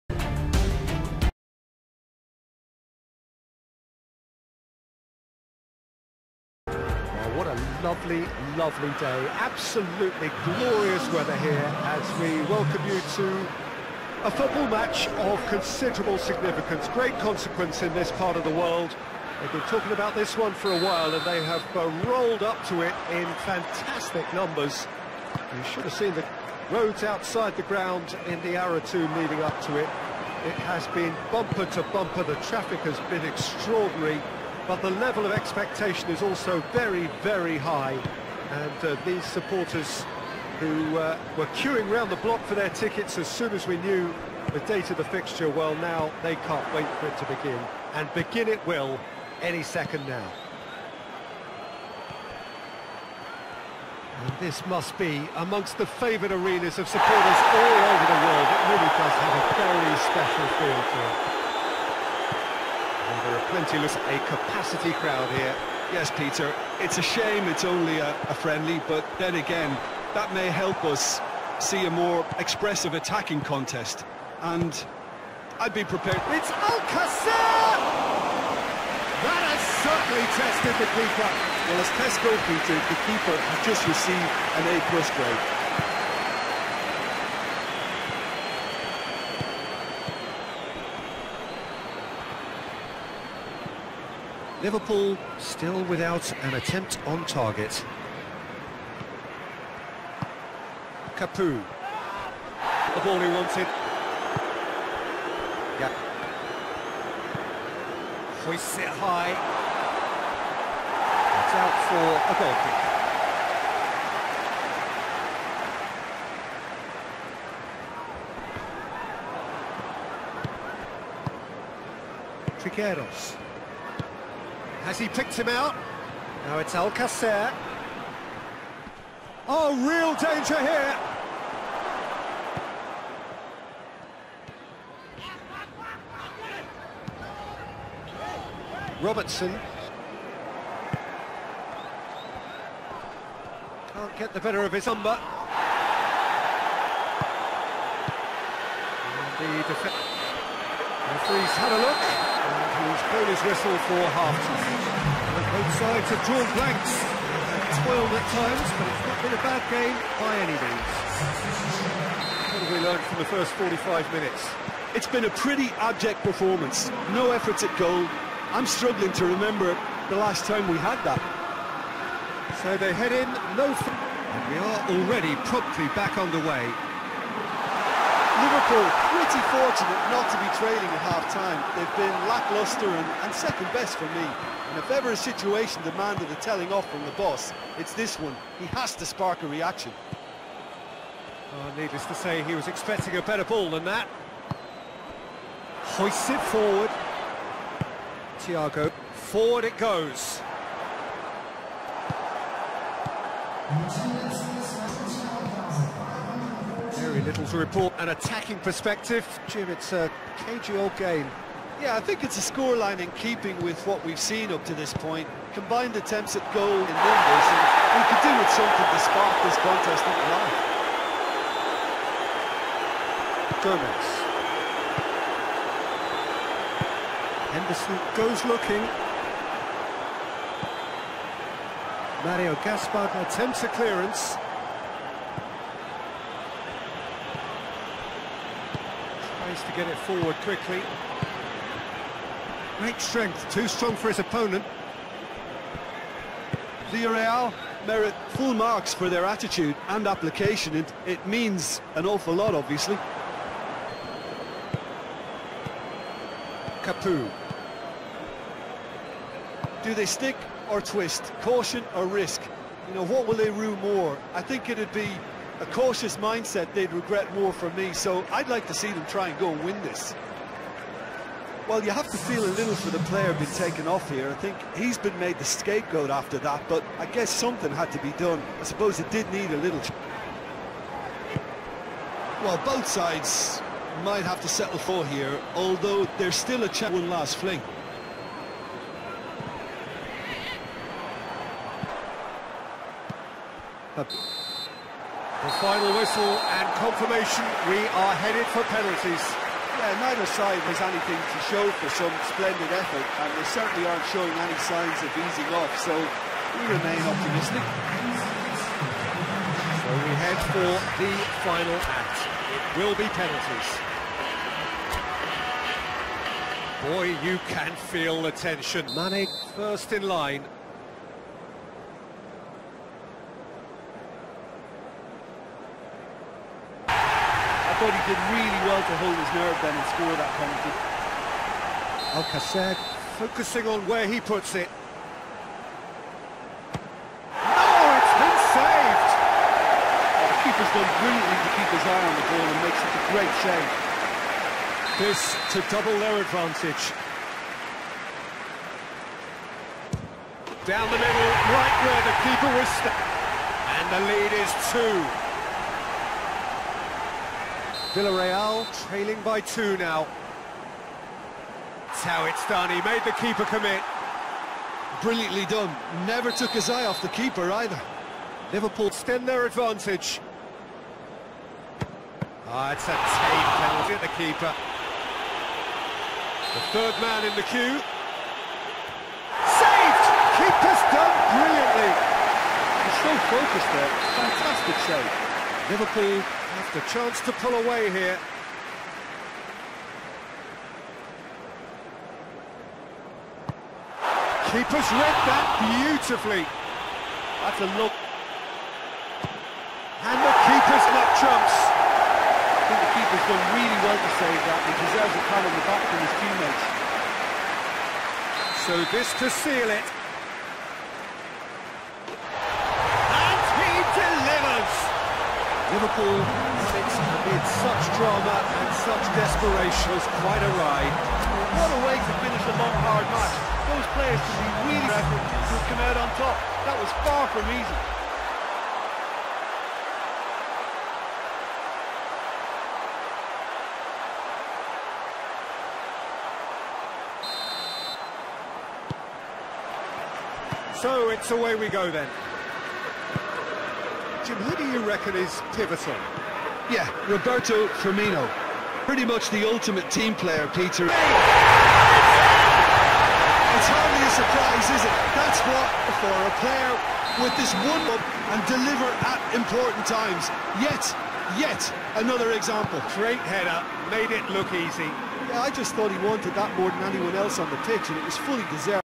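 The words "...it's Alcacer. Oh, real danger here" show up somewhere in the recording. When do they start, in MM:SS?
02:06.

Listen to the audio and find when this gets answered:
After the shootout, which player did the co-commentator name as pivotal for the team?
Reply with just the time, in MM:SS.
07:27.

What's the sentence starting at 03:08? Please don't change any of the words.
He has to spark a reaction.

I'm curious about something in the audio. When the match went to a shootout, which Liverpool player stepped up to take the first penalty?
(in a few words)
Mane.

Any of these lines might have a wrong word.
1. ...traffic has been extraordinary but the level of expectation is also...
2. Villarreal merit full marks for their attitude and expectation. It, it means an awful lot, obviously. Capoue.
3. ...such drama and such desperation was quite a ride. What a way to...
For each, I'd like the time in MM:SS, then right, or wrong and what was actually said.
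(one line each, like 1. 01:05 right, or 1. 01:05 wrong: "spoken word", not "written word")
1. 00:32 right
2. 04:06 wrong: "application", not "expectation"
3. 06:57 right.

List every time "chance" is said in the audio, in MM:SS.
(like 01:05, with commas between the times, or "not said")
04:46, 06:26.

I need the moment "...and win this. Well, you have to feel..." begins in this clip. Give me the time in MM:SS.
04:29.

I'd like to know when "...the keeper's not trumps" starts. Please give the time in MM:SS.
06:40.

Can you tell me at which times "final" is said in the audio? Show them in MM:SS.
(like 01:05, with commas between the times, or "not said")
04:55, 05:11.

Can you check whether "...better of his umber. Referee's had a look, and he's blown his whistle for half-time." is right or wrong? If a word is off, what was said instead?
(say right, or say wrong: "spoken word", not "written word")
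right.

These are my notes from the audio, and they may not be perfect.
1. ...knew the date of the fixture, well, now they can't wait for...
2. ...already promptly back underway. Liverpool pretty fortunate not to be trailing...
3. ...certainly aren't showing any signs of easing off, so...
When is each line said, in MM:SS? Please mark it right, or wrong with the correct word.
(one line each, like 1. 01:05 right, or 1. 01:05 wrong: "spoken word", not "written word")
1. 00:43 right
2. 02:54 right
3. 05:03 right.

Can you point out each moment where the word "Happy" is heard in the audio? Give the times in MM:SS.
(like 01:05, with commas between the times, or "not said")
04:53.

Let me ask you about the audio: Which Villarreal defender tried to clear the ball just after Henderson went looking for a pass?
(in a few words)
Mario Gaspar.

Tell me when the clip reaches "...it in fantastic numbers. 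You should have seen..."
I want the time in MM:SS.
00:22.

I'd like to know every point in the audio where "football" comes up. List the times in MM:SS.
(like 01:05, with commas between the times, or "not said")
00:14.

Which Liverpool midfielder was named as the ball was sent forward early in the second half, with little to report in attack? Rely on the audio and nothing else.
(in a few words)
Thiago.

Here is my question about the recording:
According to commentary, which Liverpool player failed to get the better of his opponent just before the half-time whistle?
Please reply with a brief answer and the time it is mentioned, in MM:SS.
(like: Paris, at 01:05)
Robertson, at 02:19.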